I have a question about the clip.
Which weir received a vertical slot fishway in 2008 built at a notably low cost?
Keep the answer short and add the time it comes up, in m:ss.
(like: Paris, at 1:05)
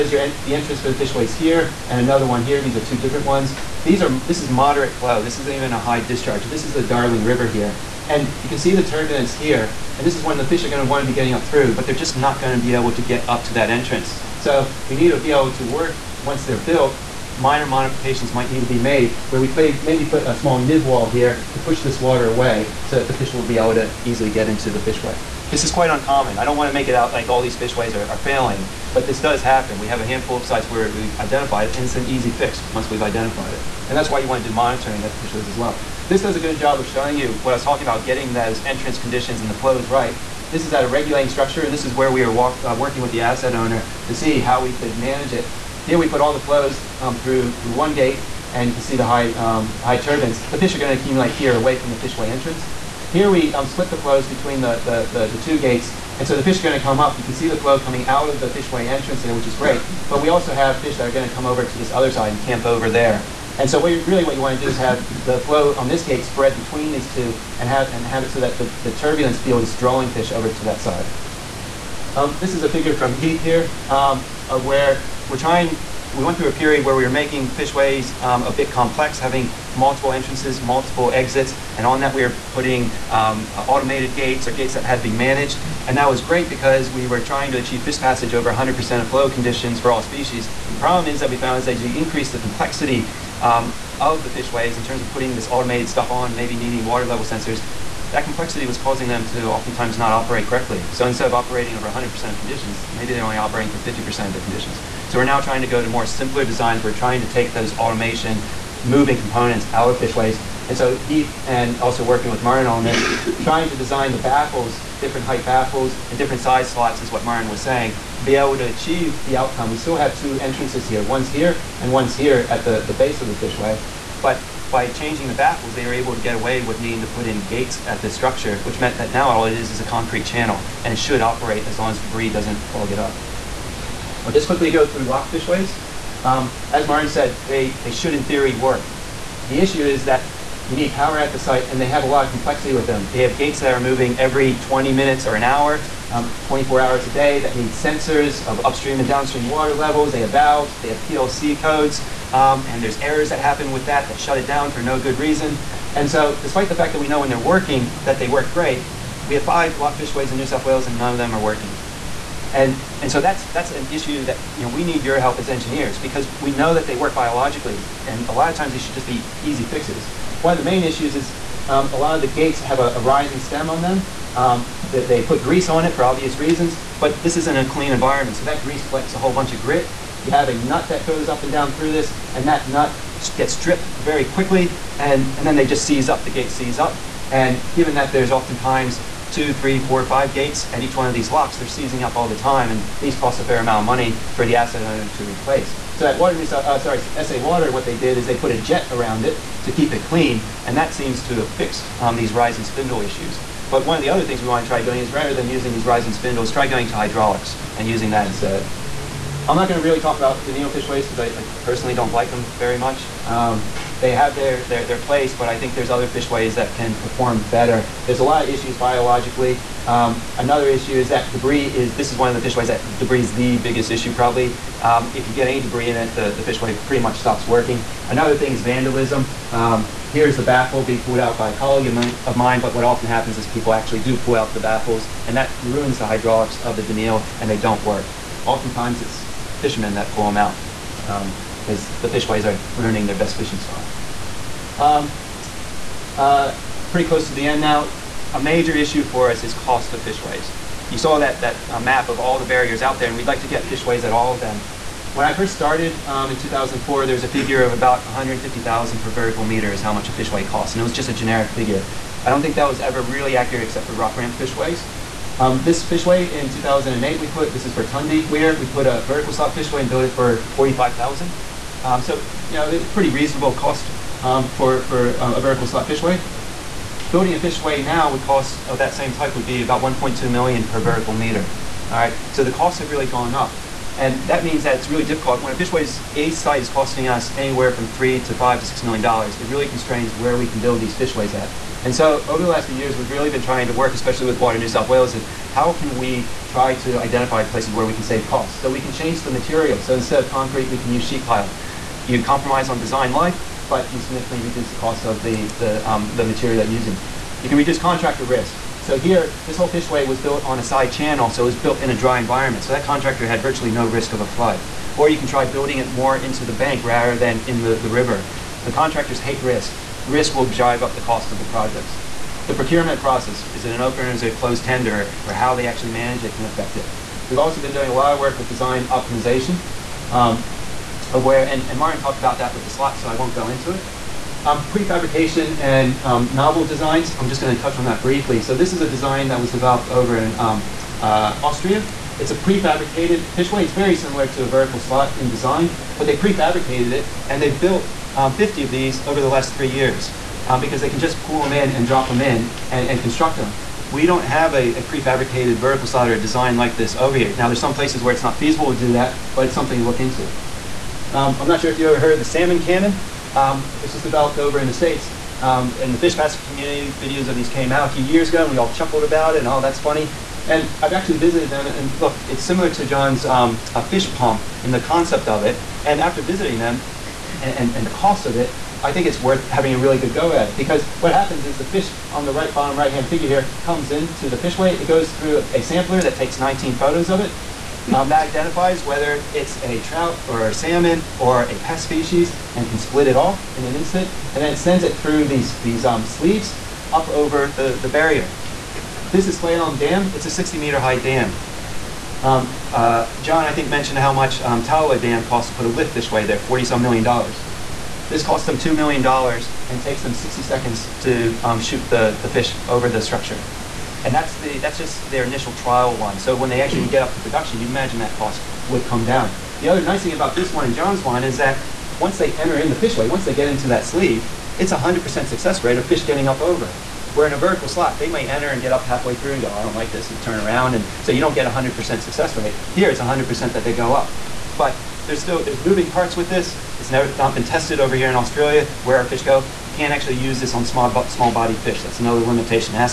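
Bertundi Weir, at 4:27.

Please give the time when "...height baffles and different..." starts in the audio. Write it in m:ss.
1:55.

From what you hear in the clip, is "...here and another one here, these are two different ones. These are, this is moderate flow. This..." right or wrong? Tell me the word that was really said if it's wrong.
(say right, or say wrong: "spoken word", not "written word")
right.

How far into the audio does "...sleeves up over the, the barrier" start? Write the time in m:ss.
6:36.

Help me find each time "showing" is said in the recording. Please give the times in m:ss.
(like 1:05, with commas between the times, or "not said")
0:36.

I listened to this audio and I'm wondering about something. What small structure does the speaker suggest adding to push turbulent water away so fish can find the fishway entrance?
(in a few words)
nib wall.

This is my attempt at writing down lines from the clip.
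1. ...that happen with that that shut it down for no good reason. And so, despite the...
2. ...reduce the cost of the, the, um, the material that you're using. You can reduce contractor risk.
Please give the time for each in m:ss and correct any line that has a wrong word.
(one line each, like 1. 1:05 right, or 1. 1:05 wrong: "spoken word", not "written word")
1. 2:33 right
2. 5:04 right.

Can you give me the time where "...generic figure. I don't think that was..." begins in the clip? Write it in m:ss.
4:21.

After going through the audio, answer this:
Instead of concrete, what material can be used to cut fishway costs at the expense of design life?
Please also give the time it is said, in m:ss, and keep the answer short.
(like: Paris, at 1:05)
sheet pile, at 5:01.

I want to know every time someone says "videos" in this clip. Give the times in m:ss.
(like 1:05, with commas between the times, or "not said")
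6:06.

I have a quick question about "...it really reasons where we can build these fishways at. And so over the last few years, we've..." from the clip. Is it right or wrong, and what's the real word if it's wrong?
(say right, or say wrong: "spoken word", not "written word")
wrong: "constrains", not "reasons".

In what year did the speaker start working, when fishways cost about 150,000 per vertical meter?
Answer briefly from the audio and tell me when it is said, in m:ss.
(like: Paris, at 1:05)
2004, at 4:16.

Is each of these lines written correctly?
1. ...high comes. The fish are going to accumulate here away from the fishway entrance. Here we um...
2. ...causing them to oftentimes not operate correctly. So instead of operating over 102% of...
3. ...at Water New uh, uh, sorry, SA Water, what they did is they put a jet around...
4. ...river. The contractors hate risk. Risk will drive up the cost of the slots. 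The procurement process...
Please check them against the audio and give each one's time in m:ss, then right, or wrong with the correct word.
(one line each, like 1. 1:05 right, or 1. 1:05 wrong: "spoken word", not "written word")
1. 0:49 wrong: "turbines", not "comes"
2. 1:38 wrong: "100", not "102"
3. 3:16 right
4. 5:17 wrong: "projects", not "slots".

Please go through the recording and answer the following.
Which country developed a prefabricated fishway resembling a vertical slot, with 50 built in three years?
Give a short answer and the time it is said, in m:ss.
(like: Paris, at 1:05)
Austria, at 5:41.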